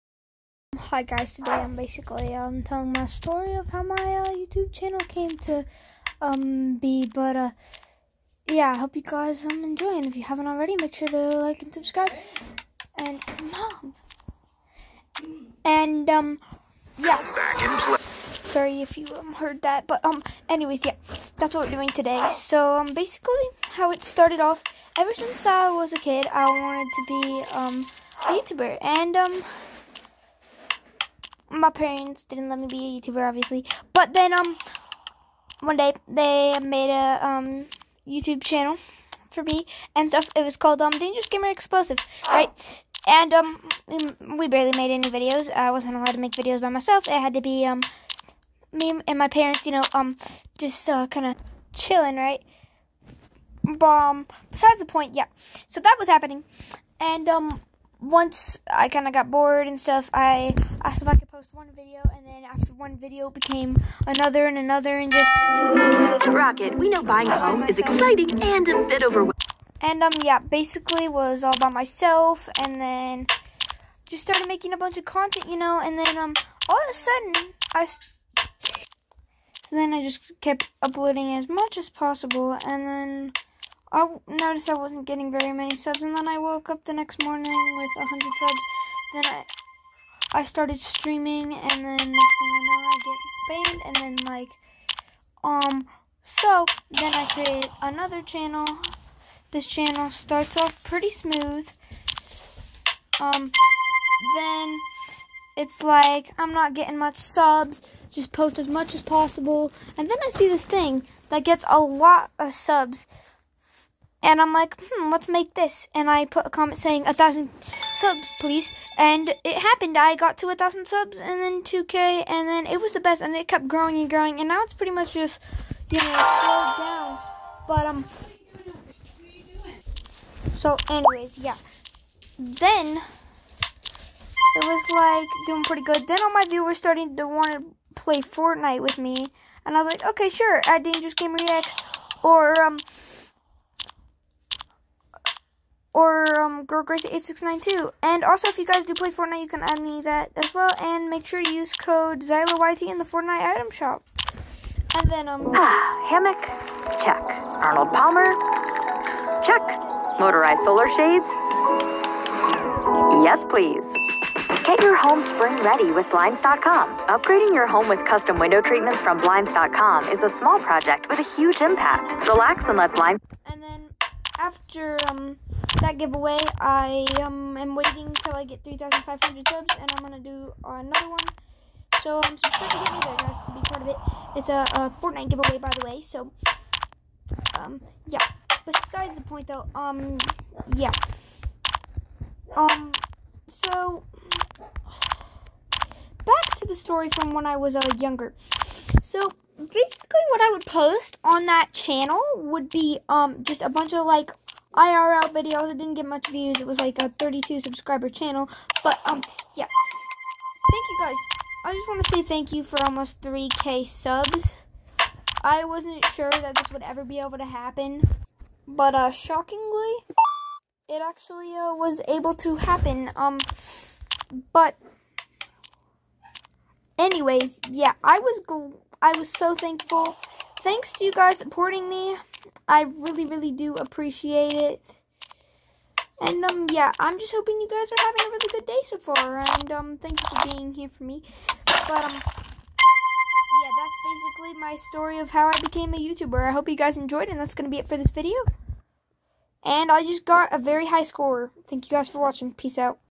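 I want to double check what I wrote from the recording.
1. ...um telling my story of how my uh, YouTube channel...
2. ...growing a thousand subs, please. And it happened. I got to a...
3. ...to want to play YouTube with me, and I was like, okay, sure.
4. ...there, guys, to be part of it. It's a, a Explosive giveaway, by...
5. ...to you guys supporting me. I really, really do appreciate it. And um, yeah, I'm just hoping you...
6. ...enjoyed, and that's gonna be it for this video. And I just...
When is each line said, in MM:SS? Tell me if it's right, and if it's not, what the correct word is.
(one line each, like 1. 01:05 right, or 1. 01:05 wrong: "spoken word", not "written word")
1. 00:02 right
2. 01:56 wrong: "saying", not "growing"
3. 02:17 wrong: "Fortnite", not "YouTube"
4. 03:03 wrong: "Fortnite", not "Explosive"
5. 03:50 right
6. 04:06 right.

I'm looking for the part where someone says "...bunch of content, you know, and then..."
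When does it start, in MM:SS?
01:14.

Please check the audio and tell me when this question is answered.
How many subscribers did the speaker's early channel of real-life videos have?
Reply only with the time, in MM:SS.
03:27.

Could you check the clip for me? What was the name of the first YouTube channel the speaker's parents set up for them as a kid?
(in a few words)
Dangerous Gamer Explosive.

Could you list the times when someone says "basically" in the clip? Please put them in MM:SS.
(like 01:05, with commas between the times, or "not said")
00:01, 00:22, 01:10, 03:19, 04:04.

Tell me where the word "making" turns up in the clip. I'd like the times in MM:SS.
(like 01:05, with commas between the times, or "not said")
01:14.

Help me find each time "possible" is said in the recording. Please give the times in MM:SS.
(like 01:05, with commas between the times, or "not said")
01:21, 01:49.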